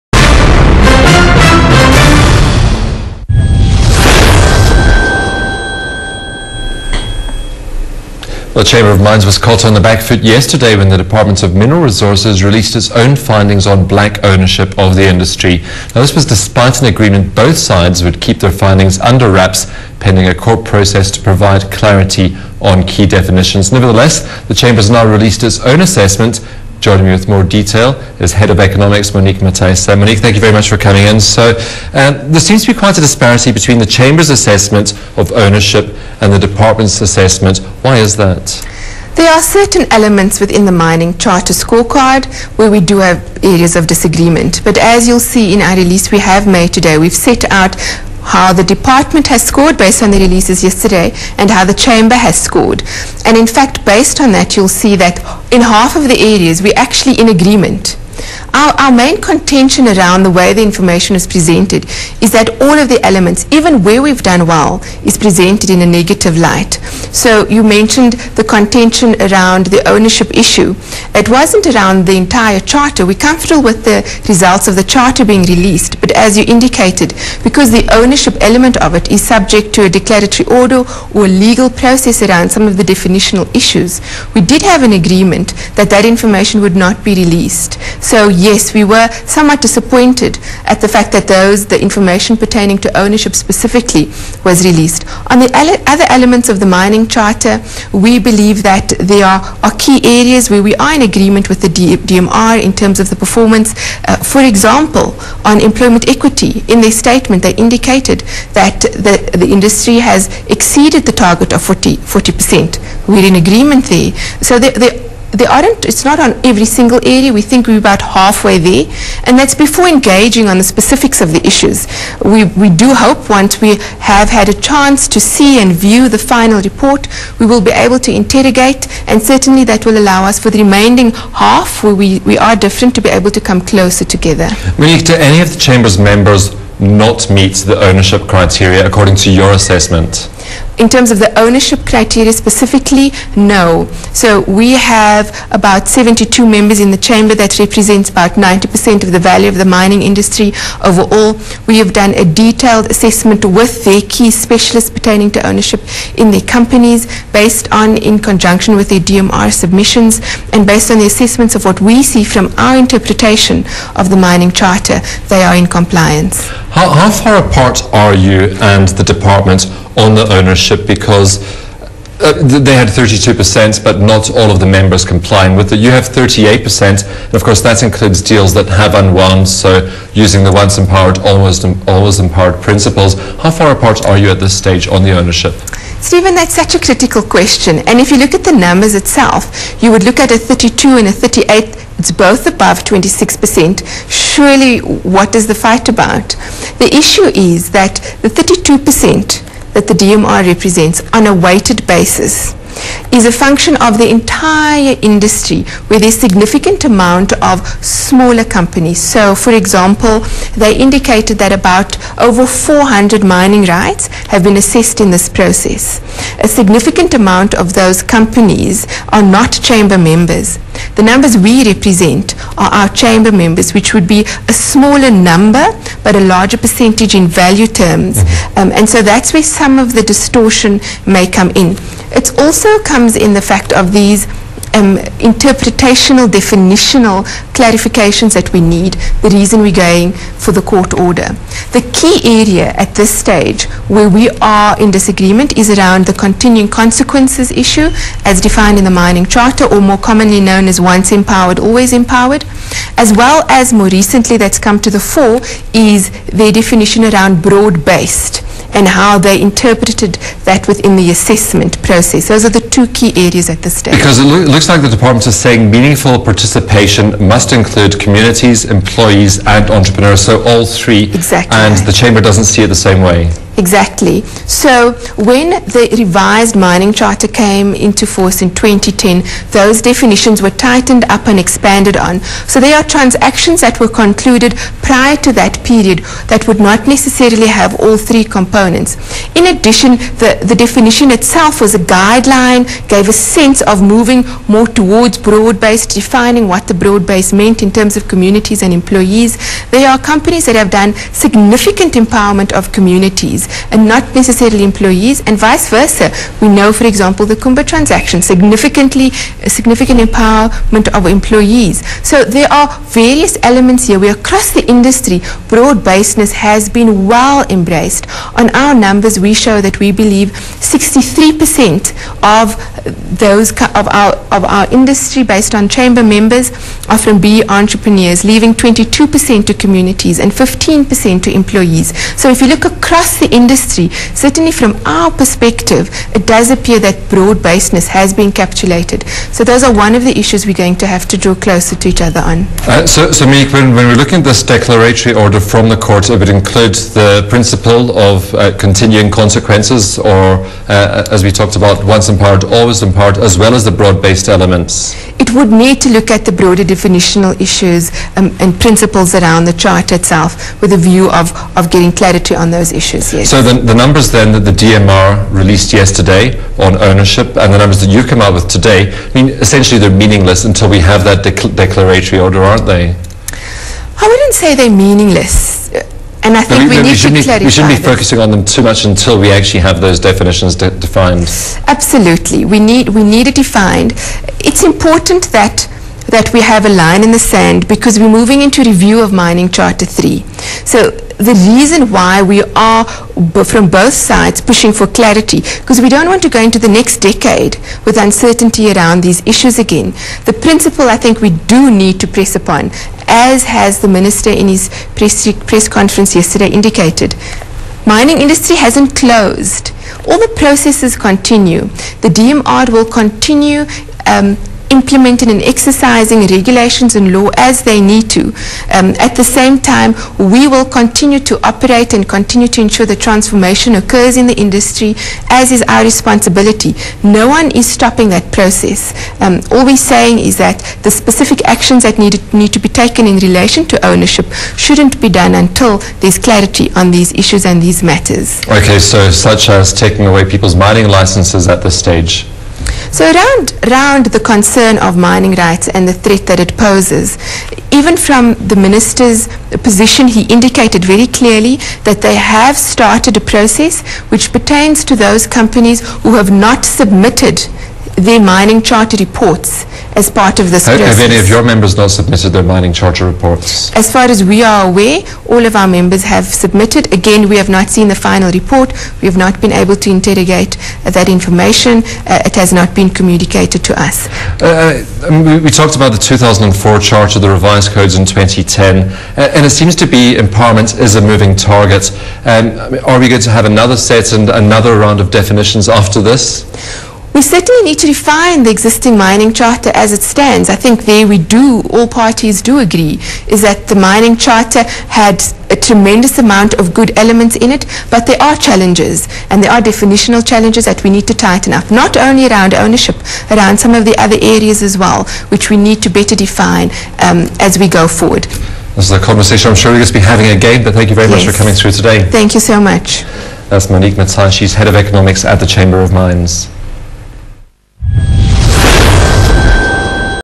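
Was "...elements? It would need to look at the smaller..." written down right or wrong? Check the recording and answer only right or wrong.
wrong.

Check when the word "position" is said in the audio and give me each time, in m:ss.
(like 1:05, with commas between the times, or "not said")
7:29.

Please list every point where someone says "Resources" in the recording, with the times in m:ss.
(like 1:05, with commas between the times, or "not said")
0:11.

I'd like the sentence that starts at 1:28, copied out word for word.
So yes, we were somewhat disappointed at the fact that those, the information pertaining to ownership specifically was released.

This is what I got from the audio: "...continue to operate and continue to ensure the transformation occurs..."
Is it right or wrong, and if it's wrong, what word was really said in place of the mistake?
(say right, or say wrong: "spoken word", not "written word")
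right.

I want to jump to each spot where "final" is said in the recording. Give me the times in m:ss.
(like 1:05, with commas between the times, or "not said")
2:06, 7:47.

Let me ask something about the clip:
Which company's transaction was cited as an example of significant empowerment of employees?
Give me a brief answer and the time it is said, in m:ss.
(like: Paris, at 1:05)
Kumba, at 5:07.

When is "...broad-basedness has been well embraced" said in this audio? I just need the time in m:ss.
5:15.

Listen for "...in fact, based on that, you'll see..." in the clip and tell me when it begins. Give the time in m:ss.
0:53.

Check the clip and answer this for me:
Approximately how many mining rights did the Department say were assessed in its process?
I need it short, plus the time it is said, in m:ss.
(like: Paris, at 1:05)
over 400, at 3:32.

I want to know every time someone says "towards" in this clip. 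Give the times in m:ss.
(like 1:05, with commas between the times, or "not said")
4:54.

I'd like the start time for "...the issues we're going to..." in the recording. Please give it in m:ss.
5:40.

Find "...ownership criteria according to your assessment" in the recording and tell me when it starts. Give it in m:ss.
2:17.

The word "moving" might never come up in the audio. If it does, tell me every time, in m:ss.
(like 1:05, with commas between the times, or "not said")
4:53, 6:28, 8:01.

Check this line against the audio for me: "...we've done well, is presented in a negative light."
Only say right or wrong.
right.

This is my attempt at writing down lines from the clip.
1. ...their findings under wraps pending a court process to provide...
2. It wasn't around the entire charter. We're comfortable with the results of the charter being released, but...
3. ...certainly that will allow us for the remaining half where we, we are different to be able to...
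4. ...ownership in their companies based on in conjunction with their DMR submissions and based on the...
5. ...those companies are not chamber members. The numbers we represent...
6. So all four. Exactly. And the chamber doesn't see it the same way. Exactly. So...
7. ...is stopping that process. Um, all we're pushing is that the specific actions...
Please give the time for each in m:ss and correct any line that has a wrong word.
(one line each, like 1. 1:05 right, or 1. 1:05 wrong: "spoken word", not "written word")
1. 0:18 right
2. 1:11 right
3. 2:09 right
4. 2:35 right
5. 3:37 right
6. 4:30 wrong: "three", not "four"
7. 7:07 wrong: "saying", not "pushing".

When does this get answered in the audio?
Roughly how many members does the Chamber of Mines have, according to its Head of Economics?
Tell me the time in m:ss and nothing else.
2:25.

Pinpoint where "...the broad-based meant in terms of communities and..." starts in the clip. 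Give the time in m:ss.
4:56.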